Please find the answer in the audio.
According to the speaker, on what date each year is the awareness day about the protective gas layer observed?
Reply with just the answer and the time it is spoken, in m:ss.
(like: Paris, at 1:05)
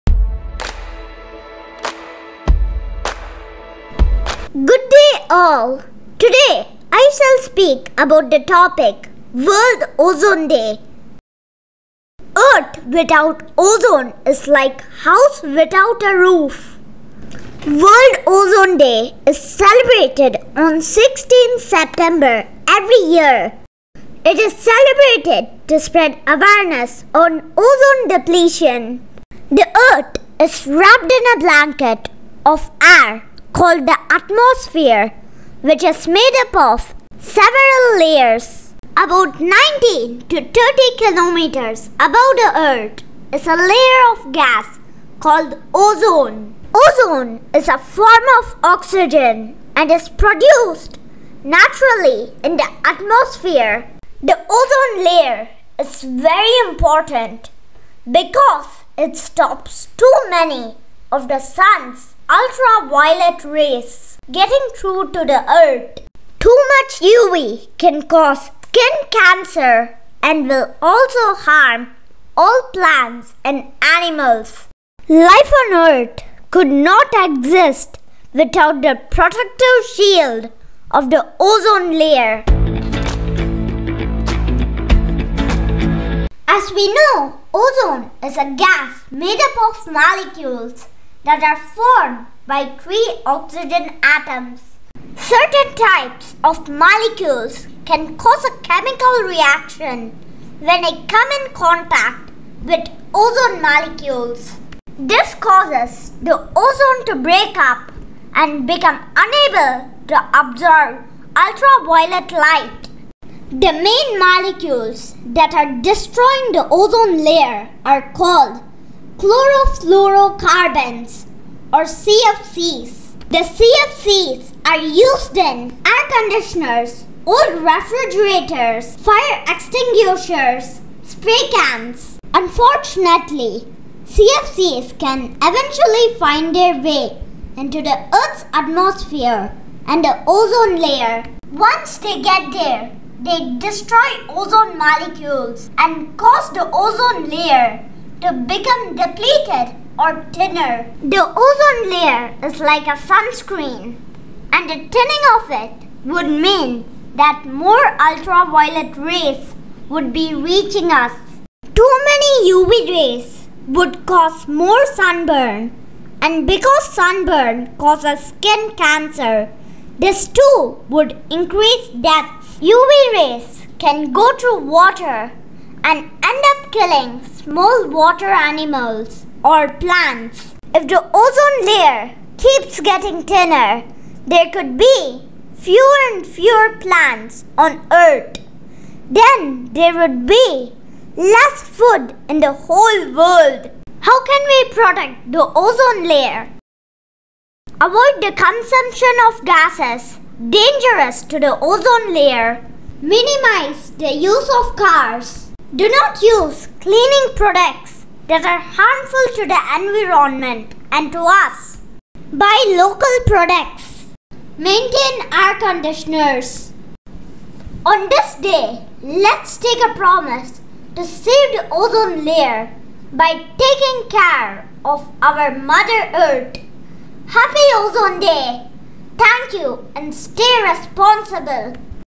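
16 September, at 0:20.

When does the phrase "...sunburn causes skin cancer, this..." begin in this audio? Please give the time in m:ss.
2:46.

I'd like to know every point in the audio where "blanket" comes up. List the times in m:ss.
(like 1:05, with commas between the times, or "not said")
0:31.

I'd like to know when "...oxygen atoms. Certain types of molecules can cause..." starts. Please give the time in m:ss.
1:33.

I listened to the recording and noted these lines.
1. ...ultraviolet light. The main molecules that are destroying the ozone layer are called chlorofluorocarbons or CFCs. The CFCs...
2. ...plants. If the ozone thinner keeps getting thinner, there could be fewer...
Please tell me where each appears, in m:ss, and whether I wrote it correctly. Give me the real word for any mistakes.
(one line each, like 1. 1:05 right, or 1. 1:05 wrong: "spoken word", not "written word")
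1. 1:51 right
2. 2:59 wrong: "layer", not "thinner".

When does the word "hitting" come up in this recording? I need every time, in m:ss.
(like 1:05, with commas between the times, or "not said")
not said.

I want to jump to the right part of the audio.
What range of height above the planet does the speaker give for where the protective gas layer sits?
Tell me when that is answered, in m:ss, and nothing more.
0:39.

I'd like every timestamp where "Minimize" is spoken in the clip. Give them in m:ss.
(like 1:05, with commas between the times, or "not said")
3:23.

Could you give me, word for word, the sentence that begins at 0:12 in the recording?
Earth without ozone is like house without a roof.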